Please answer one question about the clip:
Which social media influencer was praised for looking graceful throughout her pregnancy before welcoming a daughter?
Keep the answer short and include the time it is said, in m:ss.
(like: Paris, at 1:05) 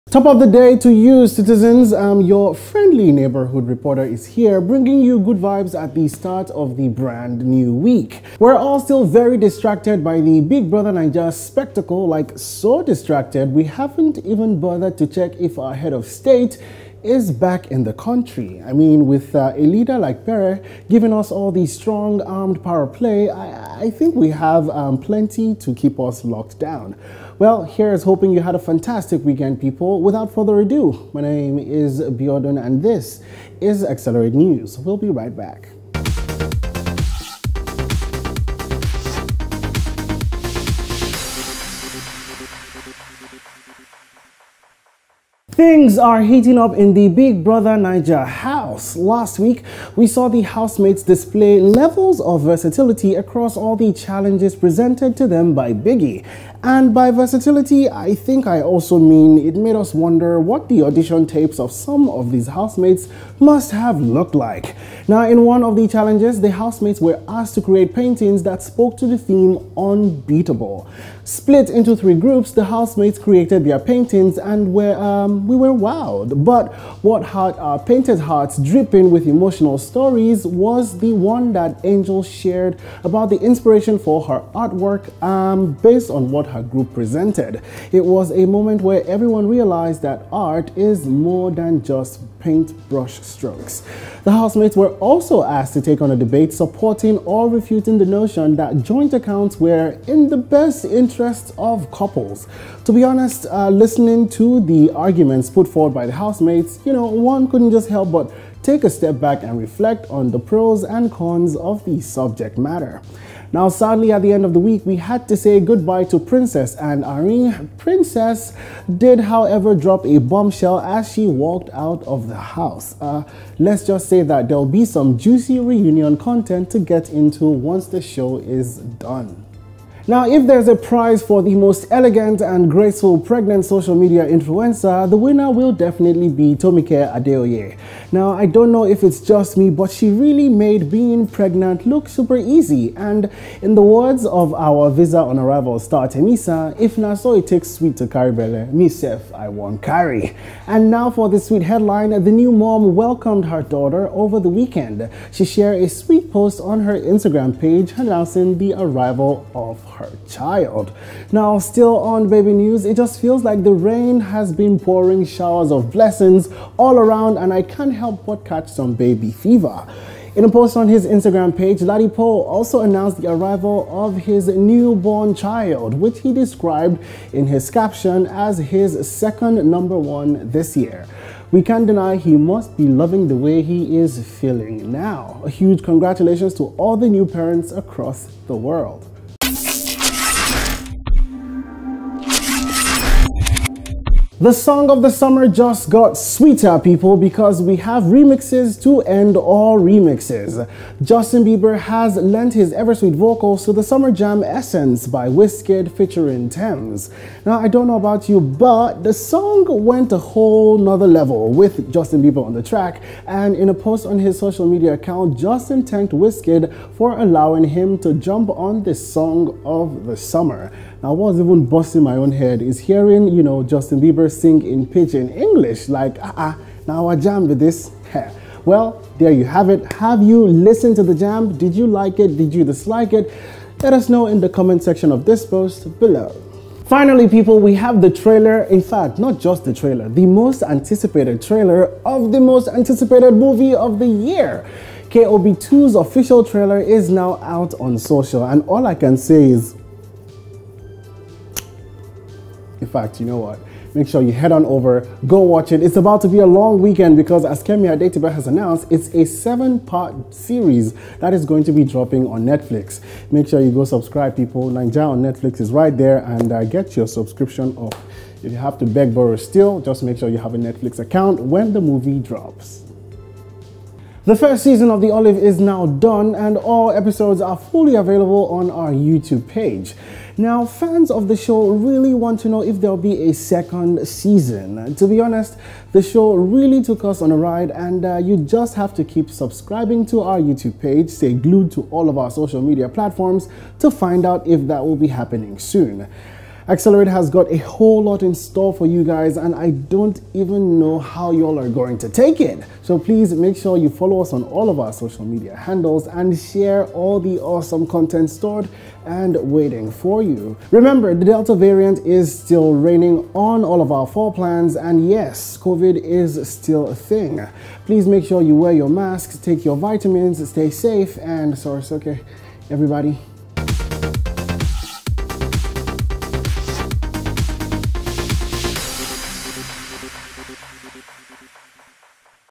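Tomike Adeoye, at 2:16.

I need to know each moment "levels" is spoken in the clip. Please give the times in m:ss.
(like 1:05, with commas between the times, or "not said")
0:51, 3:31.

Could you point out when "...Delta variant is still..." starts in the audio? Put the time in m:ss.
5:11.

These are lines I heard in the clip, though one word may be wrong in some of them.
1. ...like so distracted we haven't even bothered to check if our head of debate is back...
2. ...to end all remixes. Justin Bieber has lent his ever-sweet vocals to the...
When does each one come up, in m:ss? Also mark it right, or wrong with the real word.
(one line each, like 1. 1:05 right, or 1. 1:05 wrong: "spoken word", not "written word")
1. 0:12 wrong: "state", not "debate"
2. 3:18 right.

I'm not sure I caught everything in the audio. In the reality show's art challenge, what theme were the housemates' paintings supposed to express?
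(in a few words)
Unbeatable.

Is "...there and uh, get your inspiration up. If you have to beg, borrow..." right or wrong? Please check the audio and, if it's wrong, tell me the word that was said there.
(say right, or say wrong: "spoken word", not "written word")
wrong: "subscription", not "inspiration".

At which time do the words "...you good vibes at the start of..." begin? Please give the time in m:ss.
0:05.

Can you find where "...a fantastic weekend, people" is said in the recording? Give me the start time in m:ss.
0:28.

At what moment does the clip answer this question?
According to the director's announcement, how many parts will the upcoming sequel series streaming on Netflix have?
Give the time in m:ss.
4:19.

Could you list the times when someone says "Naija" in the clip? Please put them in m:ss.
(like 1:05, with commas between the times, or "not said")
0:10, 0:47.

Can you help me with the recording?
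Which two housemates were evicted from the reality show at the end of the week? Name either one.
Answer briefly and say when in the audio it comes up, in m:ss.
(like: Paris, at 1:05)
Princess and Irene, at 1:56.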